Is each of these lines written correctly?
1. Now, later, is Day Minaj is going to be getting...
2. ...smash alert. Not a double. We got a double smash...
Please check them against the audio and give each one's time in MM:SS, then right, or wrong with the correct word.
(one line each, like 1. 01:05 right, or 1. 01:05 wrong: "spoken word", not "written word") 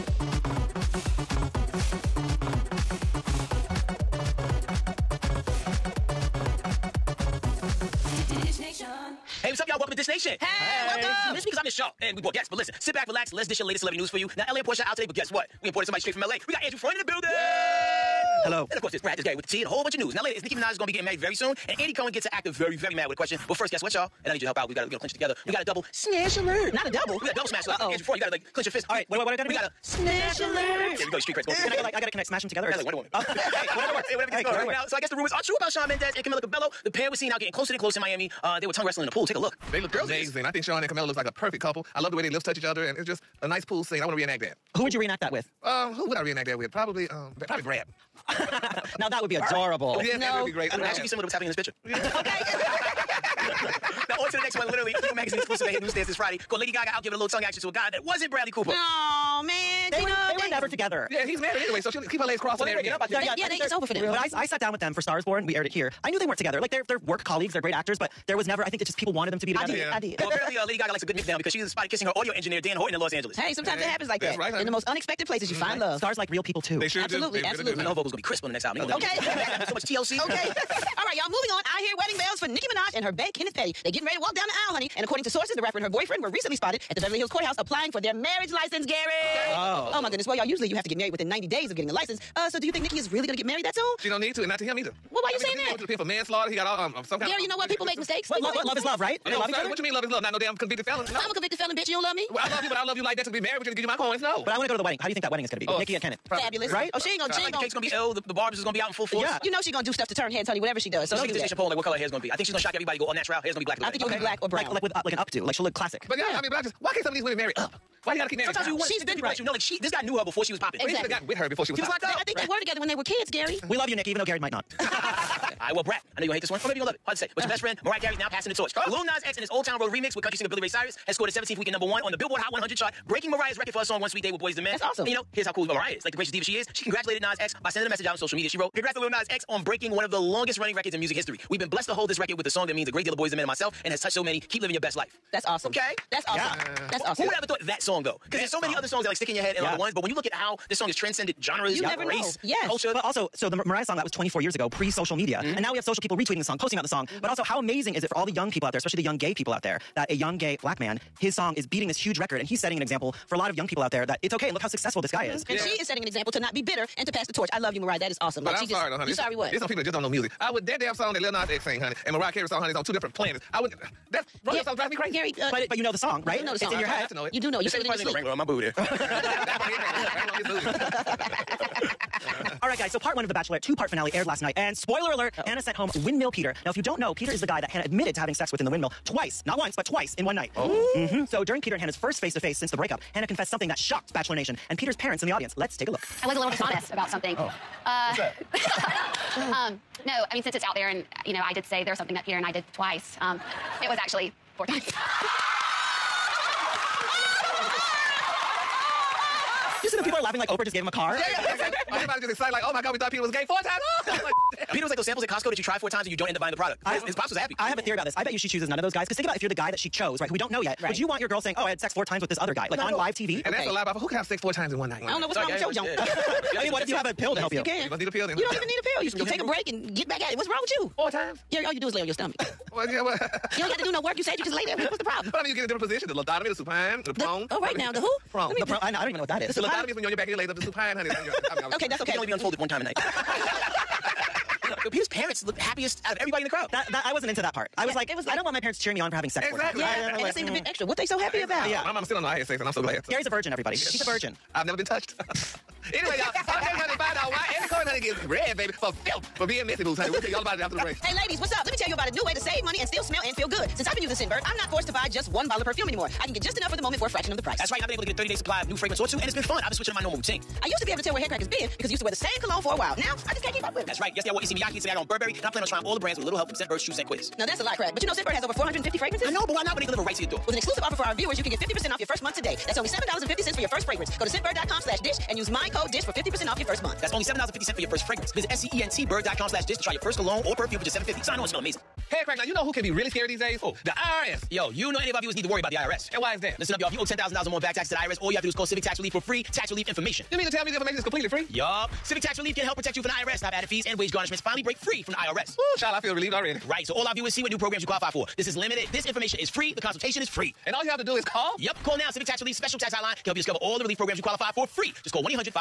1. 00:20 wrong: "Nicki", not "Day"
2. 00:25 right.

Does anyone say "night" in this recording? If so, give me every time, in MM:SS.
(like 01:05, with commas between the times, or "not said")
03:04, 03:10, 03:44, 04:02.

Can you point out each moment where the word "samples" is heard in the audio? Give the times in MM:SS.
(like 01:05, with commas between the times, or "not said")
03:35.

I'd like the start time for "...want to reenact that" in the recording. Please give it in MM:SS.
00:44.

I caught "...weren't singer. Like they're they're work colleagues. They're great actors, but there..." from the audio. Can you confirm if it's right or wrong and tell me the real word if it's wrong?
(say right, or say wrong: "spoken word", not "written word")
wrong: "together", not "singer".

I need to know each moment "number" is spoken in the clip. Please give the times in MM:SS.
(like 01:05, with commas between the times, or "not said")
02:11.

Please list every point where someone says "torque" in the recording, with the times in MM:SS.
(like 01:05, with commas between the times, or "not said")
not said.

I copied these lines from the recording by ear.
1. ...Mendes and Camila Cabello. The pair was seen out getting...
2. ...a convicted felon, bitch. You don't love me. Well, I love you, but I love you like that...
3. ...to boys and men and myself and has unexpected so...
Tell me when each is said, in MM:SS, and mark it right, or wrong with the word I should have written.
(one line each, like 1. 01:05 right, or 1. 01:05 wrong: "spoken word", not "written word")
1. 00:35 right
2. 01:41 right
3. 02:23 wrong: "touched", not "unexpected".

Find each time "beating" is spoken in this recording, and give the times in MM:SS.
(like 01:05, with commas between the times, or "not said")
02:41.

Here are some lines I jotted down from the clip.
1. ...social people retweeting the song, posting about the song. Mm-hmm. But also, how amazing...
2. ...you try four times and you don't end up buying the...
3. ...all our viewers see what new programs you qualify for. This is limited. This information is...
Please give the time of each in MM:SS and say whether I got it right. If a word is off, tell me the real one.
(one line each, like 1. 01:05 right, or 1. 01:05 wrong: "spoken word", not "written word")
1. 02:35 right
2. 03:35 right
3. 05:06 right.